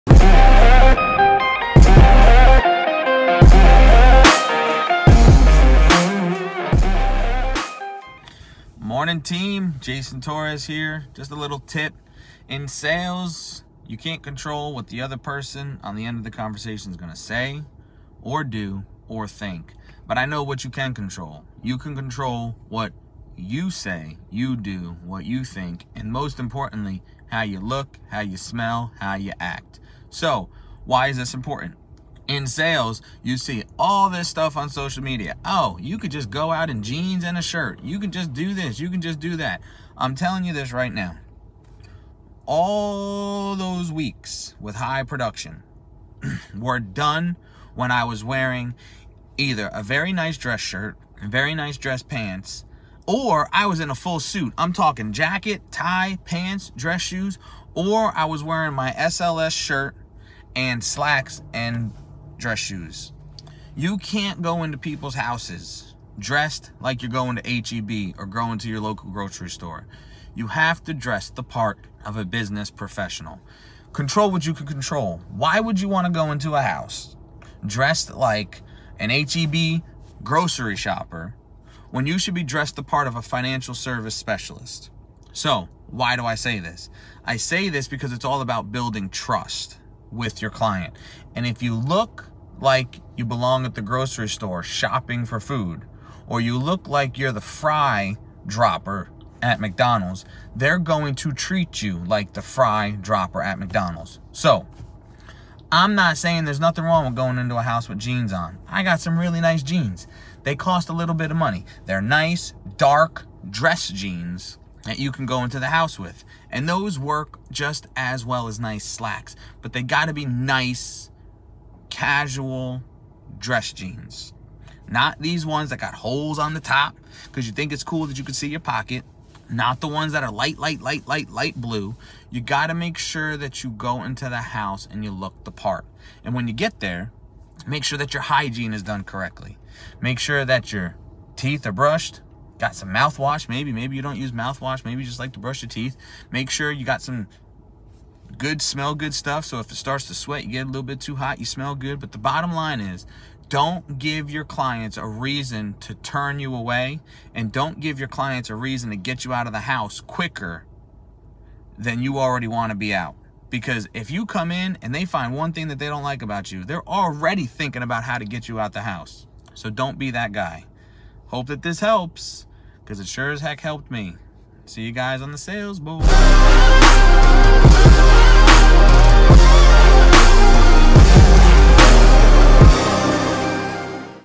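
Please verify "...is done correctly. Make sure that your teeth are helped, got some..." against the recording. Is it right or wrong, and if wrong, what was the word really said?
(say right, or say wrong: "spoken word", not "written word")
wrong: "brushed", not "helped".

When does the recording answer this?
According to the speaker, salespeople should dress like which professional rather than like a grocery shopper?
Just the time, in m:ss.
1:23.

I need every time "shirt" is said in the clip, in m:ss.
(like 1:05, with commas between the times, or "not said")
0:37, 0:50, 0:59.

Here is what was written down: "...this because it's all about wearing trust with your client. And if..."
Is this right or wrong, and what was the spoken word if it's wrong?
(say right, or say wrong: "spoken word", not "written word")
wrong: "building", not "wearing".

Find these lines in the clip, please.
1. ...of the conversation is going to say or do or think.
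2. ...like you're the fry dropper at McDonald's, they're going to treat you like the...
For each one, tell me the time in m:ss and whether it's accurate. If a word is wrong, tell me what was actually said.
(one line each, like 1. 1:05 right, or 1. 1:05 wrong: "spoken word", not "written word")
1. 0:16 right
2. 1:36 right.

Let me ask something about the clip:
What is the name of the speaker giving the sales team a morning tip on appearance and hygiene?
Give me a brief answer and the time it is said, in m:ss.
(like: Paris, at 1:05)
Jason Torres, at 0:09.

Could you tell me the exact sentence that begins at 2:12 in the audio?
You got to make sure that you go into the house and you look the part.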